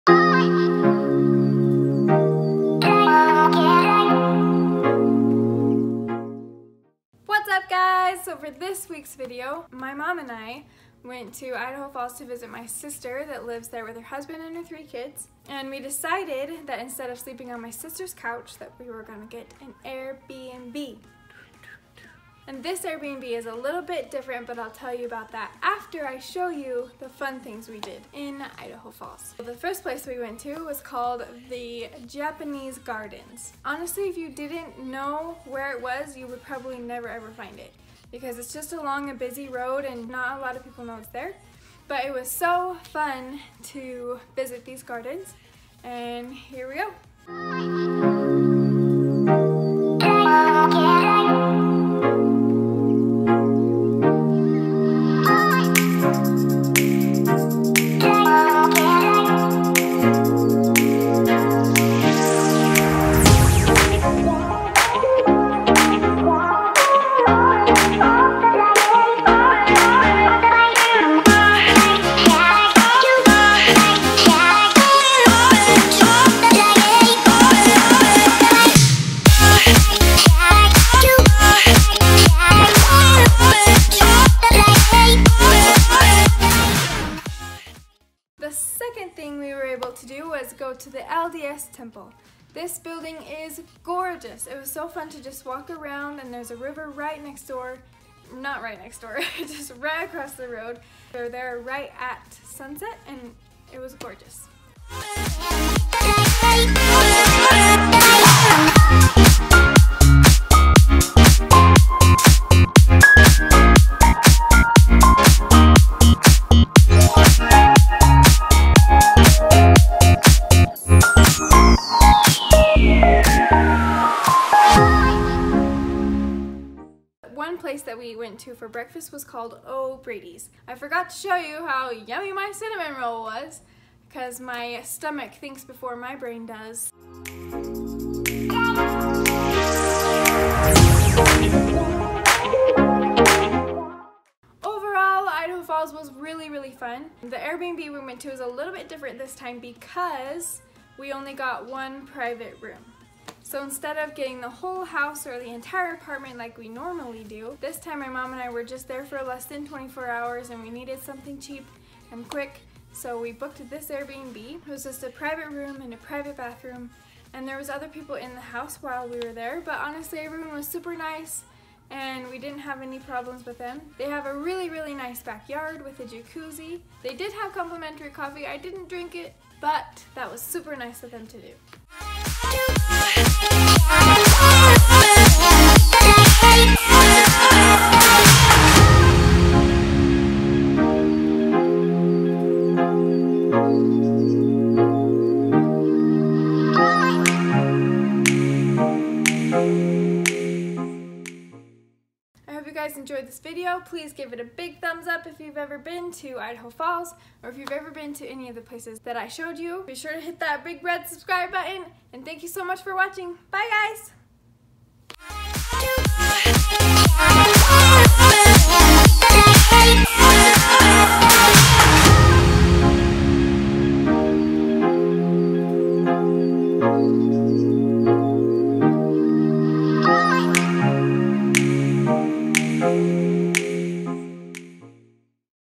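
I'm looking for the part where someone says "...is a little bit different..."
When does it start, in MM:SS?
00:23.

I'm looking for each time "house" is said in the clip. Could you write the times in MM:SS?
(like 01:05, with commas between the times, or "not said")
02:34, 02:48.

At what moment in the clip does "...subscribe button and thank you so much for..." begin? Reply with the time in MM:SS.
03:31.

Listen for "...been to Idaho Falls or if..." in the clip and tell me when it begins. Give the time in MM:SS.
03:25.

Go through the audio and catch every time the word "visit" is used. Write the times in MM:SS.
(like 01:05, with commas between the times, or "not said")
00:12, 00:44.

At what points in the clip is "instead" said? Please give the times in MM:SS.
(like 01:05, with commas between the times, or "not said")
00:16, 02:33.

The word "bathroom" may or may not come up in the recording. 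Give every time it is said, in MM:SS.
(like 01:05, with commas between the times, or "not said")
02:46.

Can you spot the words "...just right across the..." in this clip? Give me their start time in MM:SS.
01:39.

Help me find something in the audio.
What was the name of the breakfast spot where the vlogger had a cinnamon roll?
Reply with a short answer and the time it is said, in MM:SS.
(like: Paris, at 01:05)
O'Brady's, at 02:09.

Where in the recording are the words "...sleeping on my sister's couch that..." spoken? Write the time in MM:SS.
00:17.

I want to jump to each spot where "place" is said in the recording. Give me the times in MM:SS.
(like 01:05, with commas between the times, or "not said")
00:29, 02:07, 03:28.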